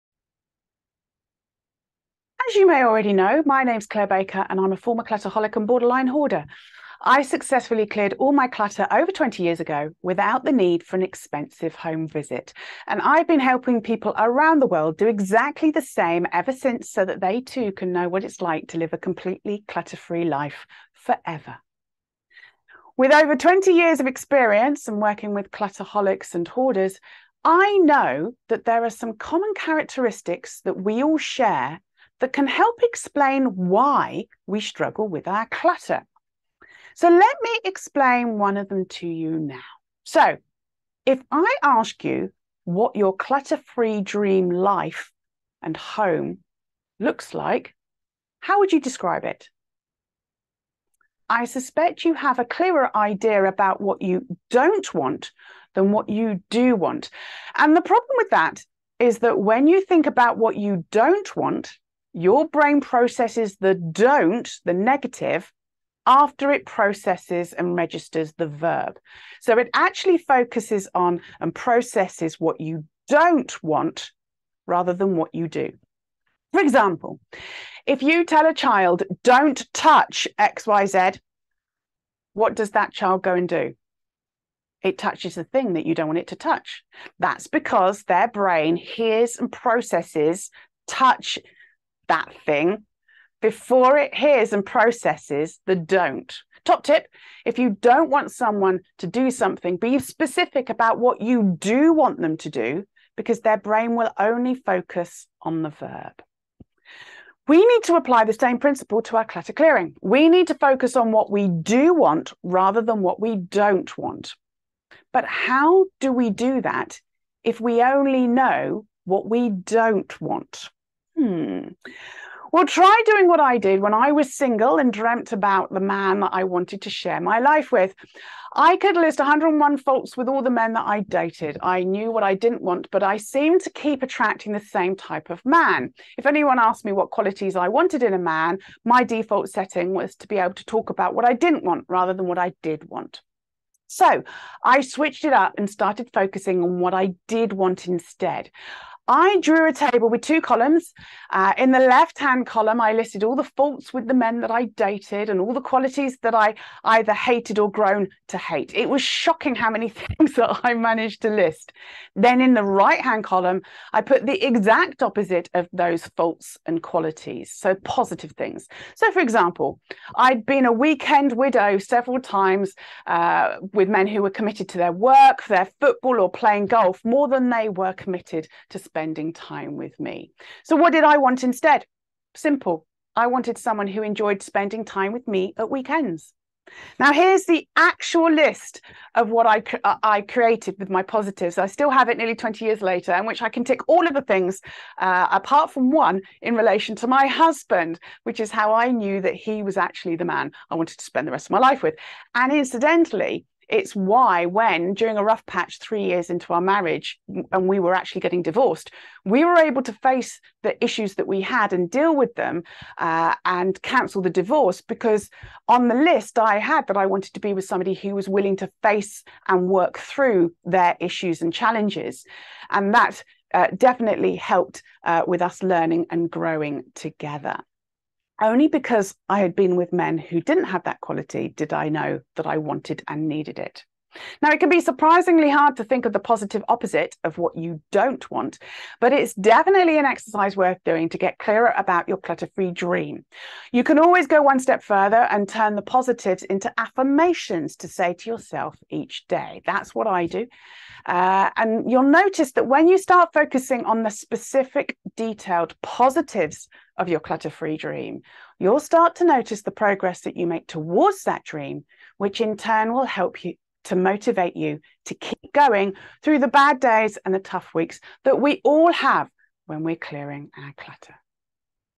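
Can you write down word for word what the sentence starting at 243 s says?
You can always go one step further and turn the positives into affirmations to say to yourself each day.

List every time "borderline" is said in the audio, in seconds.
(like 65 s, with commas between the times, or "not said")
5 s.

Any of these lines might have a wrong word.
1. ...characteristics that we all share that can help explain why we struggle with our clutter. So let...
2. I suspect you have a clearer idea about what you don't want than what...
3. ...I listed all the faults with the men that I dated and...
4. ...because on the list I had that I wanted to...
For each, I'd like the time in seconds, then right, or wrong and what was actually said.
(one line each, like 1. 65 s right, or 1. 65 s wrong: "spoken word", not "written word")
1. 29 s right
2. 51 s right
3. 152 s right
4. 214 s right.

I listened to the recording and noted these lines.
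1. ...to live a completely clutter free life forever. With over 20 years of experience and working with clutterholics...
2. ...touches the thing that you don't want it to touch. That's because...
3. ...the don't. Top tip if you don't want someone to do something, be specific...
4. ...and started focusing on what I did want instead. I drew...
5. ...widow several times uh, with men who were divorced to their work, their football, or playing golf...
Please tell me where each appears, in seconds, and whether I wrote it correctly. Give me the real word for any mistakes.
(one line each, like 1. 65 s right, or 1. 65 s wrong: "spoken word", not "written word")
1. 18 s right
2. 84 s right
3. 95 s right
4. 145 s right
5. 171 s wrong: "committed", not "divorced".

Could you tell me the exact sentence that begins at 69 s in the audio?
So it actually focuses on and processes what you don't want rather than what you do.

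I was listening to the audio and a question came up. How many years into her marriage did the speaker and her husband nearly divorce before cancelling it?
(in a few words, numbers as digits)
3.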